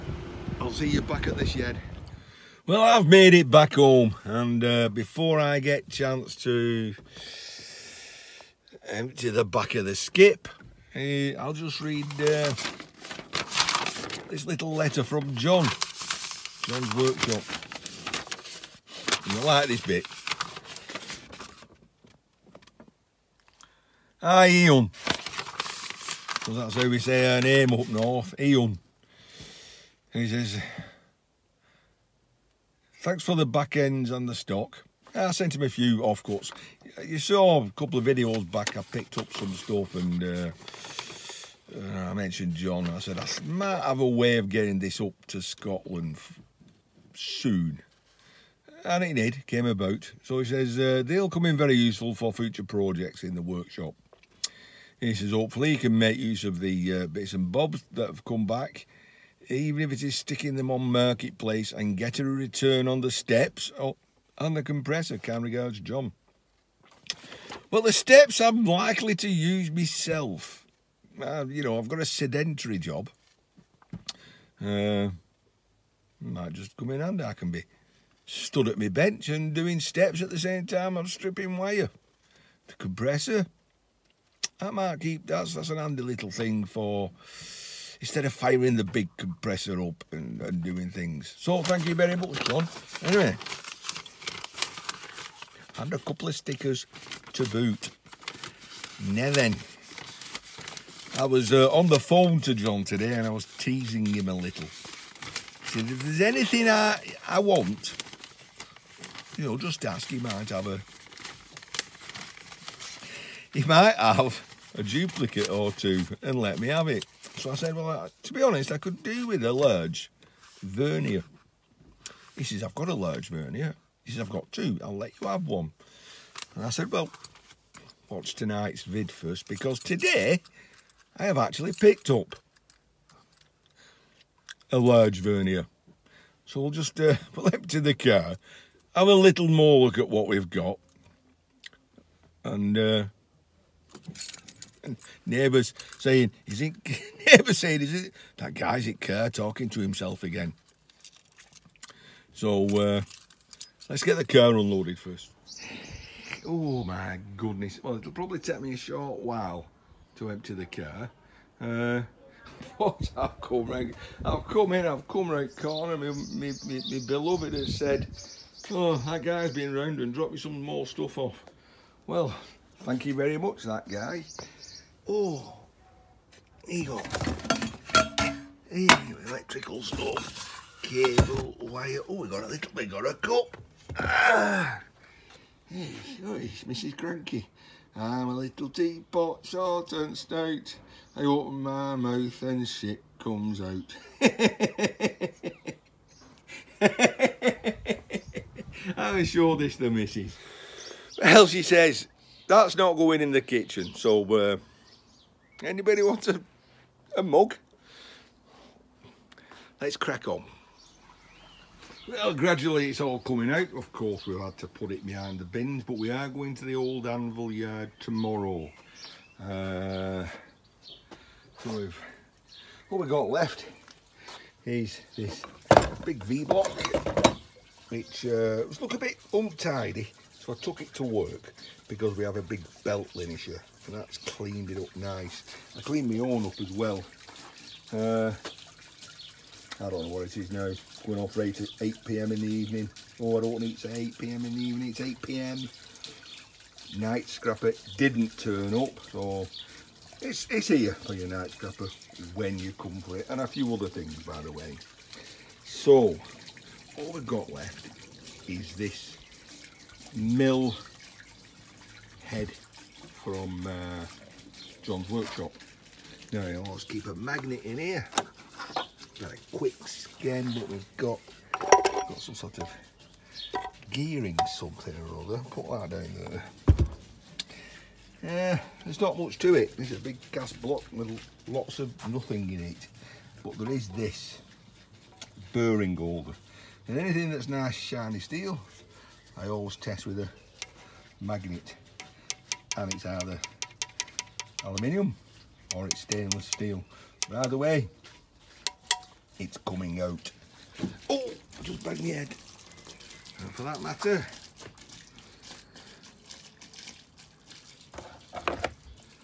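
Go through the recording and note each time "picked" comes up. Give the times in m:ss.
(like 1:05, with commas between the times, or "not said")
0:38, 2:11.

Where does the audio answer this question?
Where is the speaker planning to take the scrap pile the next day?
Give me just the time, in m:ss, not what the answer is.
3:36.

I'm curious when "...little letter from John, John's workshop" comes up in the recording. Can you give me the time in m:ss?
0:14.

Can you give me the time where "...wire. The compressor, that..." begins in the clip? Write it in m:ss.
1:21.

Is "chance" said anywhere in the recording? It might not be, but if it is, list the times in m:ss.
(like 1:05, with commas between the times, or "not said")
0:05.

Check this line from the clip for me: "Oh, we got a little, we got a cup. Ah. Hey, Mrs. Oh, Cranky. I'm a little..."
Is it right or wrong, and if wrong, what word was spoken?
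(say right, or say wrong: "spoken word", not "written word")
right.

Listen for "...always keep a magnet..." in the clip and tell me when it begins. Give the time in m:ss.
4:26.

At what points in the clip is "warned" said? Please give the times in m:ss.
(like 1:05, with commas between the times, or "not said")
not said.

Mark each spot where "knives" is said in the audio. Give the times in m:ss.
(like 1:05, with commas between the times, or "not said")
not said.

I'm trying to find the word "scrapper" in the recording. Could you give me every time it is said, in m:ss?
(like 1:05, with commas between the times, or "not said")
4:07, 4:11.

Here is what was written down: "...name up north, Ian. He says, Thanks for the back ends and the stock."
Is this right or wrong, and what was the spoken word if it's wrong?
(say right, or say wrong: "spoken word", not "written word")
wrong: "Eon", not "Ian".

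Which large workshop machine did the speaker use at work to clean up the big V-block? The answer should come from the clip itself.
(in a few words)
belt linisher.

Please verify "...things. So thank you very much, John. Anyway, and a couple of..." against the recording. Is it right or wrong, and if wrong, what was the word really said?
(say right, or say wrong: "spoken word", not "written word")
right.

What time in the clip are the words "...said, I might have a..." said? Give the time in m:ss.
0:42.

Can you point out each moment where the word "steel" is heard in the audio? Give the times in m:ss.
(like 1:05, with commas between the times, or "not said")
4:48, 4:56.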